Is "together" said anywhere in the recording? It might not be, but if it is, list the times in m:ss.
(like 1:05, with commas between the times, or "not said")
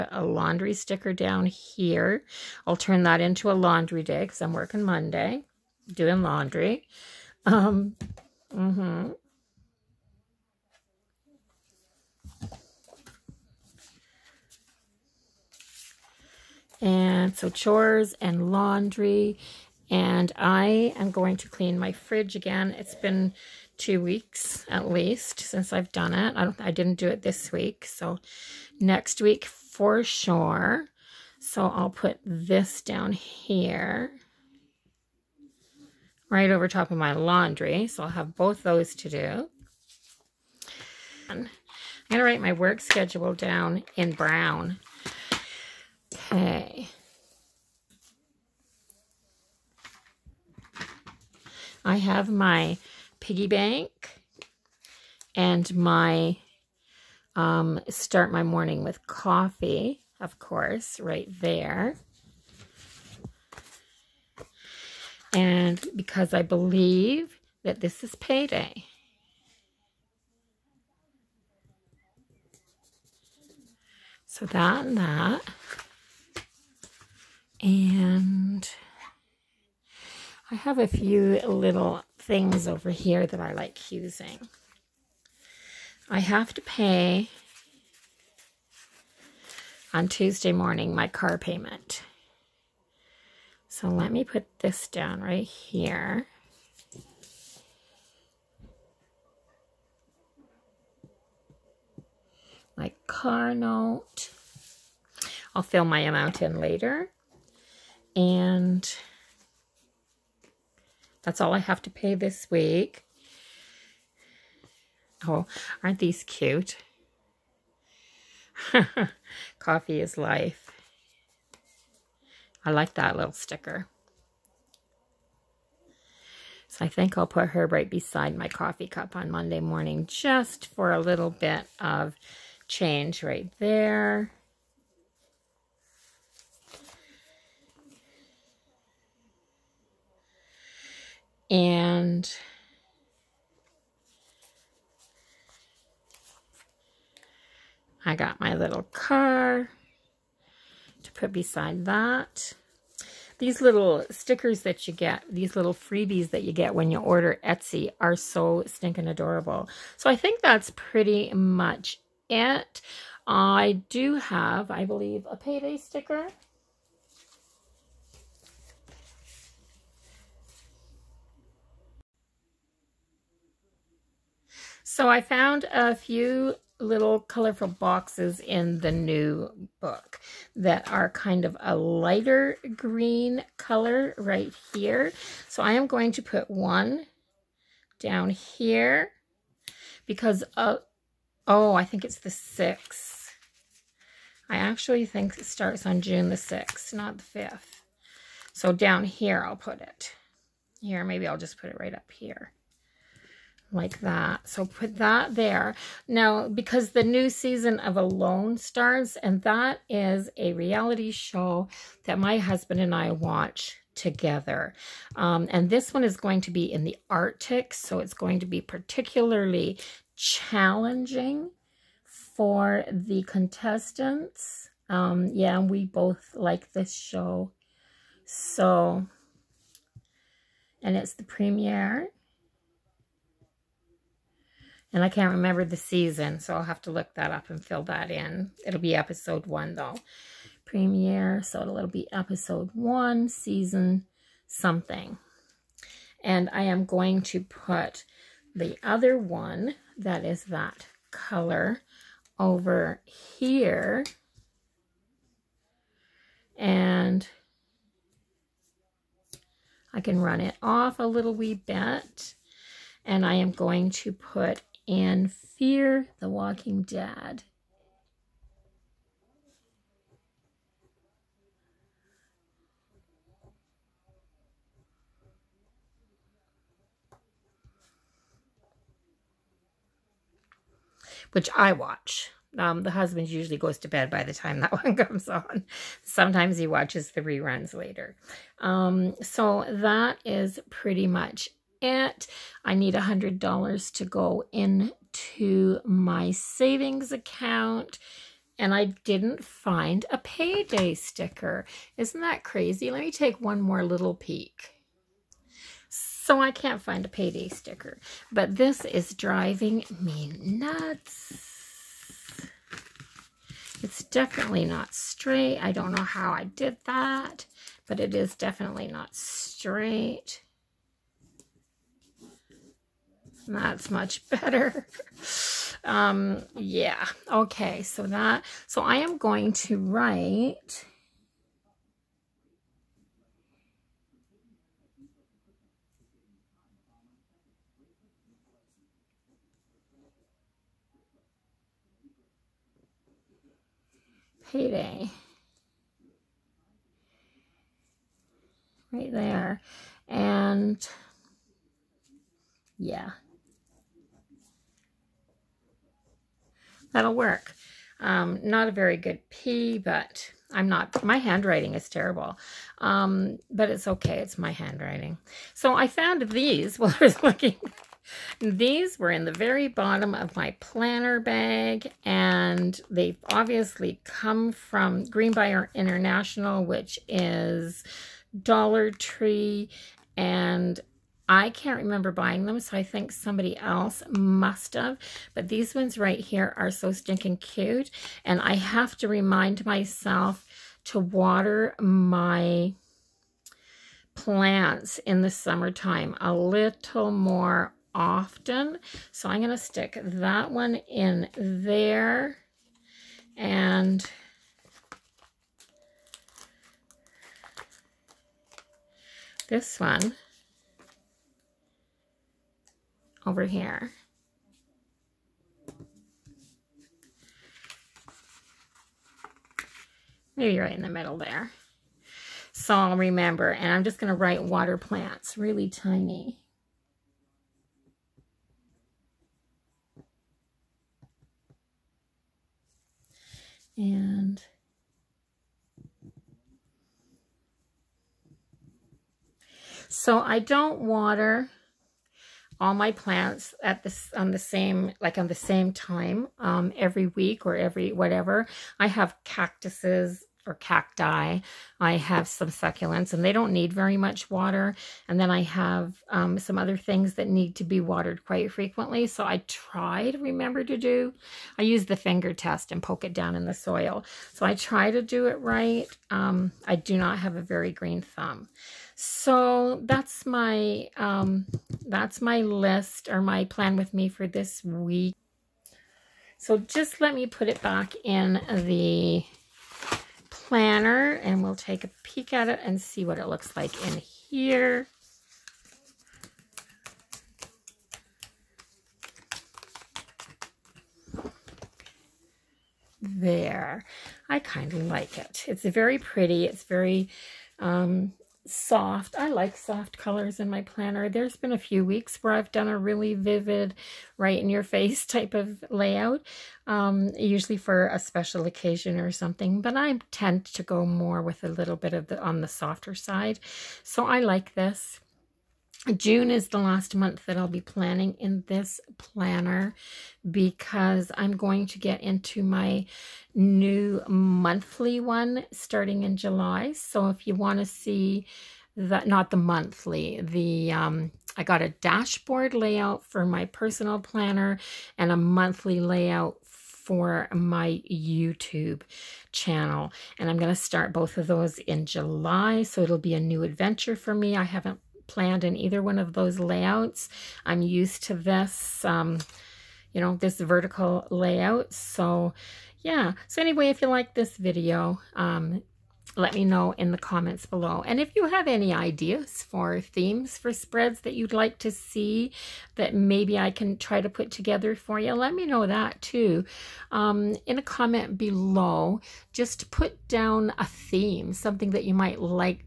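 3:33, 9:24.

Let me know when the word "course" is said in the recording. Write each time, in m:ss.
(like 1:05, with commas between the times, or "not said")
1:00.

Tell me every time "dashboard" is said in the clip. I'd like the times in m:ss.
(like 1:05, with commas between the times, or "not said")
8:51.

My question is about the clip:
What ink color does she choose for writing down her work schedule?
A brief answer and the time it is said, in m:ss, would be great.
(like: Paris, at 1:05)
Brown, at 0:44.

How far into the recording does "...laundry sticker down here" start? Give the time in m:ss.
0:00.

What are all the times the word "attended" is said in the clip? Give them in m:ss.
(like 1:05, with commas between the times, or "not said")
not said.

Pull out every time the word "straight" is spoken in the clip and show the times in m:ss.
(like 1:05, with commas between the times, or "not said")
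5:14, 5:19.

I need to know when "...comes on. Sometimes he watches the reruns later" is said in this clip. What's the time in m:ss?
4:44.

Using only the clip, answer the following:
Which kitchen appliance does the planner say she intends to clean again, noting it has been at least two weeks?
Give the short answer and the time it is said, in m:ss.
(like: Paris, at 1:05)
Fridge, at 0:21.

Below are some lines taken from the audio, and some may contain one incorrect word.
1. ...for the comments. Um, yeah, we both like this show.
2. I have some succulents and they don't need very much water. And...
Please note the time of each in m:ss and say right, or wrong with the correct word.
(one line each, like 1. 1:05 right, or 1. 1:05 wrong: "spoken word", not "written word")
1. 3:42 wrong: "contestants", not "comments"
2. 7:31 right.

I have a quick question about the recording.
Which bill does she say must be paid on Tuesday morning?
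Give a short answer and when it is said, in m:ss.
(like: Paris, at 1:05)
Car payment, at 1:31.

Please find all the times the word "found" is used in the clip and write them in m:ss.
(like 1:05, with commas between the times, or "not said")
2:55, 6:05.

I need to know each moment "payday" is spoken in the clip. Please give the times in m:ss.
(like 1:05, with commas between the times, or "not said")
1:08, 2:45, 5:00, 5:07, 5:44.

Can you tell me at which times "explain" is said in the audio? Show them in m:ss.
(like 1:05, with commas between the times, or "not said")
not said.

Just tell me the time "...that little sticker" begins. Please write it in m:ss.
2:02.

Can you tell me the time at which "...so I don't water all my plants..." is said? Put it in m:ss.
7:19.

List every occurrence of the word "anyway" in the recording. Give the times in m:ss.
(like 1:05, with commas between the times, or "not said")
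9:13.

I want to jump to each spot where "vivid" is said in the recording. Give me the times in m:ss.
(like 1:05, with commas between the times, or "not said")
8:23.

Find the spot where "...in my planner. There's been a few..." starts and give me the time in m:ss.
8:20.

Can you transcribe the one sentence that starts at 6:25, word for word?
But these ones right here are so stinking cute.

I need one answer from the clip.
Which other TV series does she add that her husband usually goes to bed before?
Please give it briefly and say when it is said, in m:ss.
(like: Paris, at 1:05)
Fear the Walking Dead, at 4:25.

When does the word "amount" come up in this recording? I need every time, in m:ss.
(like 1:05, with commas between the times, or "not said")
1:46.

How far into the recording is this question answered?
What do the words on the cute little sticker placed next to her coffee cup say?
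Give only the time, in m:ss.
1:59.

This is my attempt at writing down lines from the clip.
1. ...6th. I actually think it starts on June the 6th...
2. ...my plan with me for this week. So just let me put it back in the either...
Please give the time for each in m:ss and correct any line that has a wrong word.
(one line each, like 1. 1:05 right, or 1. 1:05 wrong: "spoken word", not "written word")
1. 3:12 right
2. 7:53 wrong: "planner", not "either".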